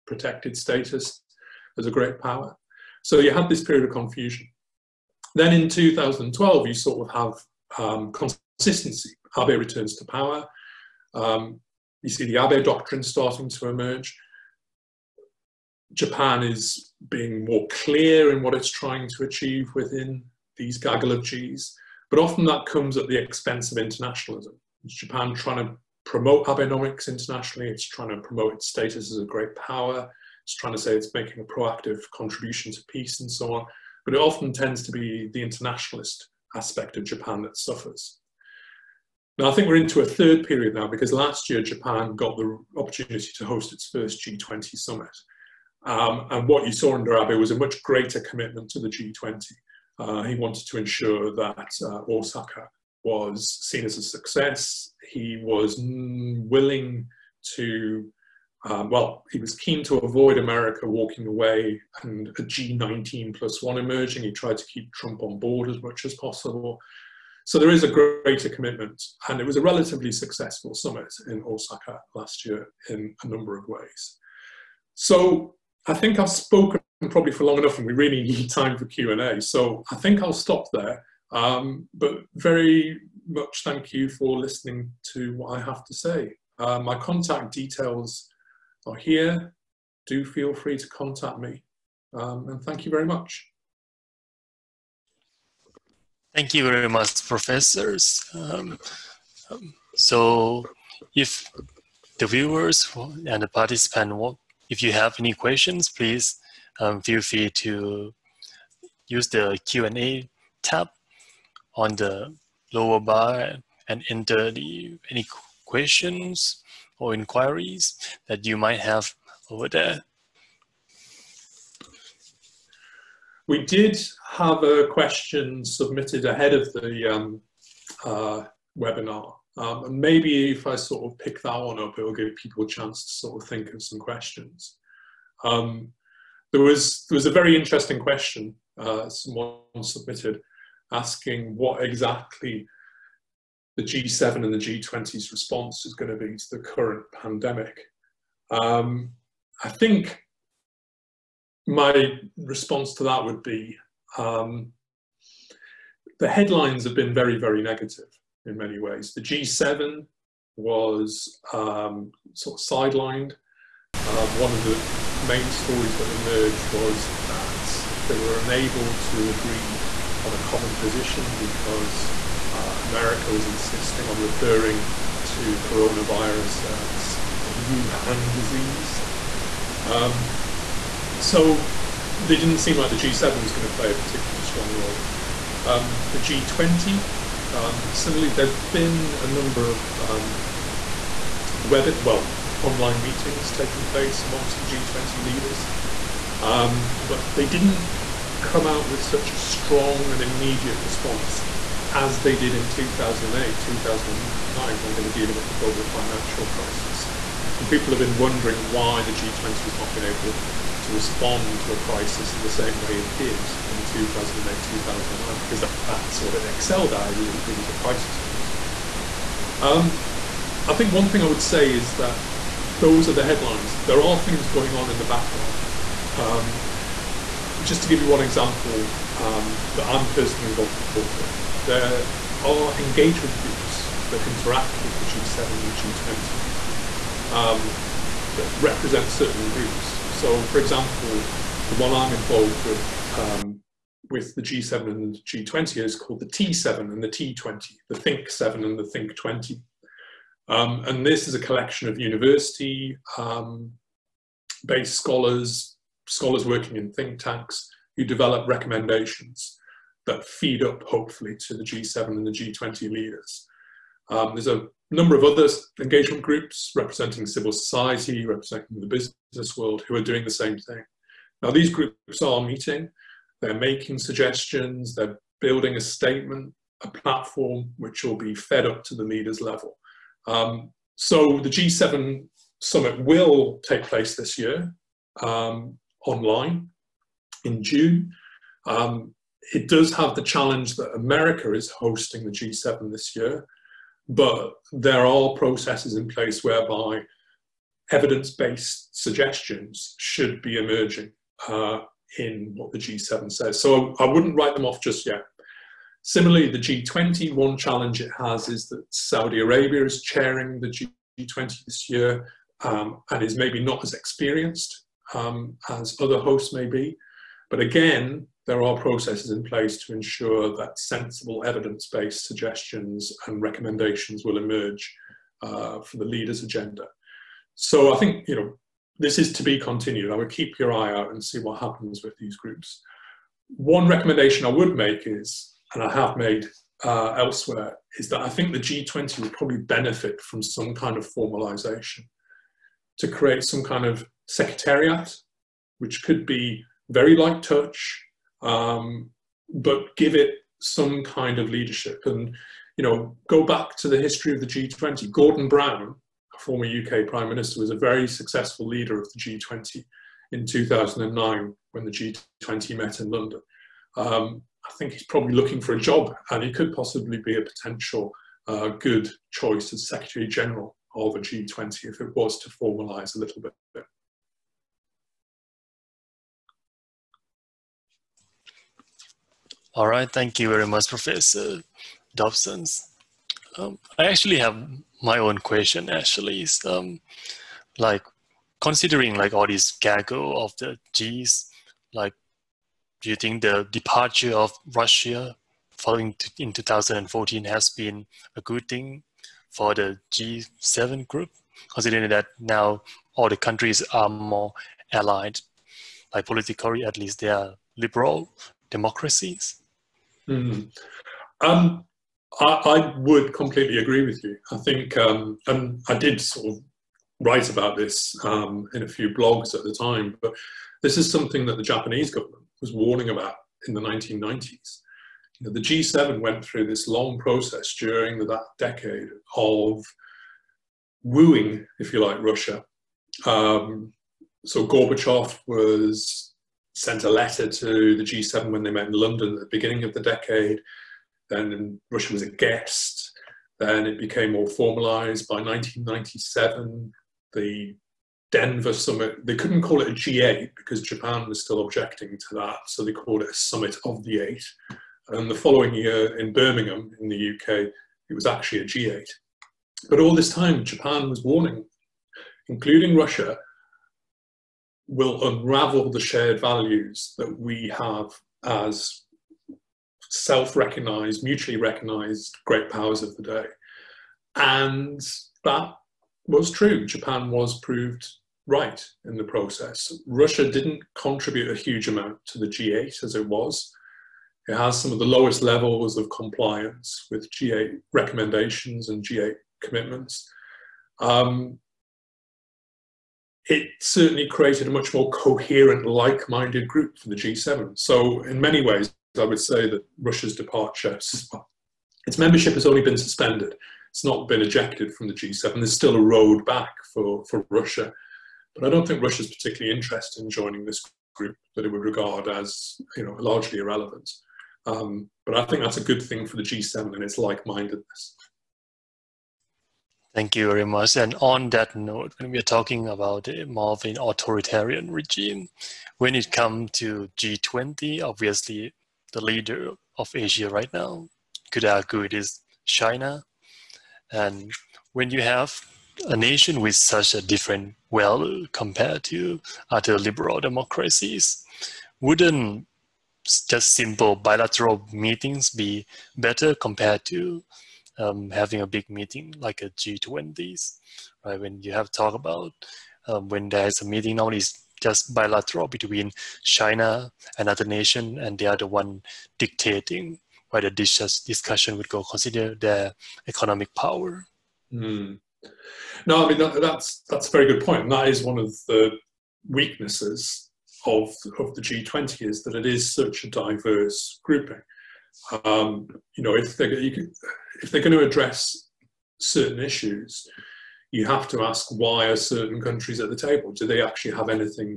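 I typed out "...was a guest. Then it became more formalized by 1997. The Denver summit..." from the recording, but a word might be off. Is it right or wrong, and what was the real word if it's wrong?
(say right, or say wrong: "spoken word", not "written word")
right.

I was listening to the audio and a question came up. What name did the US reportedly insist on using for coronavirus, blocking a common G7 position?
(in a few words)
Wuhan disease.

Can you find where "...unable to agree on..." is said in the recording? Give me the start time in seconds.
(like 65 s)
168 s.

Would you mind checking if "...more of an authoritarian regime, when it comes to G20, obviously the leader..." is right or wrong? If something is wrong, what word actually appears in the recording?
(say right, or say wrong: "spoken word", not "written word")
right.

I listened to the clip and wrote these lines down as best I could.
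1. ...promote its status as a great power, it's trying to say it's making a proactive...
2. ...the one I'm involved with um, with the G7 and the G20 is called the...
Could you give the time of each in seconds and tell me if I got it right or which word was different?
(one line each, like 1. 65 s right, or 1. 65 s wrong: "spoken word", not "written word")
1. 28 s right
2. 241 s right.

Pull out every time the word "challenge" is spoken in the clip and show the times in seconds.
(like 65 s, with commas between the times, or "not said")
290 s, 307 s.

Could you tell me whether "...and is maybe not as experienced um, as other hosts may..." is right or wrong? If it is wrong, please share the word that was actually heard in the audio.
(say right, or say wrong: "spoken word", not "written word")
right.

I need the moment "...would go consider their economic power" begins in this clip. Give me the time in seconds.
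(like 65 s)
561 s.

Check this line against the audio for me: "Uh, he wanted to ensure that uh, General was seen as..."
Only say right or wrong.
wrong.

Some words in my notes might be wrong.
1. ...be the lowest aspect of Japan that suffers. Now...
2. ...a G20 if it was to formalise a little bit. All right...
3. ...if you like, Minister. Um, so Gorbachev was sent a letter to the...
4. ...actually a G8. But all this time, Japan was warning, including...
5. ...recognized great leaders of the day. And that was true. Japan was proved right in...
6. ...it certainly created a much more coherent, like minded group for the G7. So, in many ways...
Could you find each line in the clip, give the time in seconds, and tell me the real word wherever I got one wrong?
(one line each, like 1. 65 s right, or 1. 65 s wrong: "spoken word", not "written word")
1. 34 s wrong: "internationalist", not "lowest"
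2. 371 s right
3. 431 s wrong: "Russia", not "Minister"
4. 458 s right
5. 471 s wrong: "powers", not "leaders"
6. 493 s right.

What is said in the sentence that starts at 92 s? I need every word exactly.
Um, and thank you very much.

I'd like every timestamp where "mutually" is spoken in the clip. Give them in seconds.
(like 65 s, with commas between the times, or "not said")
471 s.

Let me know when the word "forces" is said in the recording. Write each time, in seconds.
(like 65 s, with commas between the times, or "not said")
not said.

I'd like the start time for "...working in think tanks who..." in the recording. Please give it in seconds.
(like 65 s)
256 s.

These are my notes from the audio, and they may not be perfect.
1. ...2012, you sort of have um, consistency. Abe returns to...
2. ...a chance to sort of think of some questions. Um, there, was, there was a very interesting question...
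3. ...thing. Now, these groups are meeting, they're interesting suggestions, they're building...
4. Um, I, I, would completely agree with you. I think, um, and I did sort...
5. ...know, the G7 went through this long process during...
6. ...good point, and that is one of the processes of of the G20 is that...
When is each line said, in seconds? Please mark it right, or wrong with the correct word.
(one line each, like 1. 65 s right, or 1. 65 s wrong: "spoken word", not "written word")
1. 5 s right
2. 132 s right
3. 270 s wrong: "making", not "interesting"
4. 411 s right
5. 425 s right
6. 567 s wrong: "weaknesses", not "processes".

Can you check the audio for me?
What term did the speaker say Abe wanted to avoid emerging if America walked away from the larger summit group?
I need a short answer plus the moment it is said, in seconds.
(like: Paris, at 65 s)
G19 plus one, at 62 s.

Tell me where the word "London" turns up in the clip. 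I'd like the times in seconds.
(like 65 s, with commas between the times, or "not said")
363 s, 438 s.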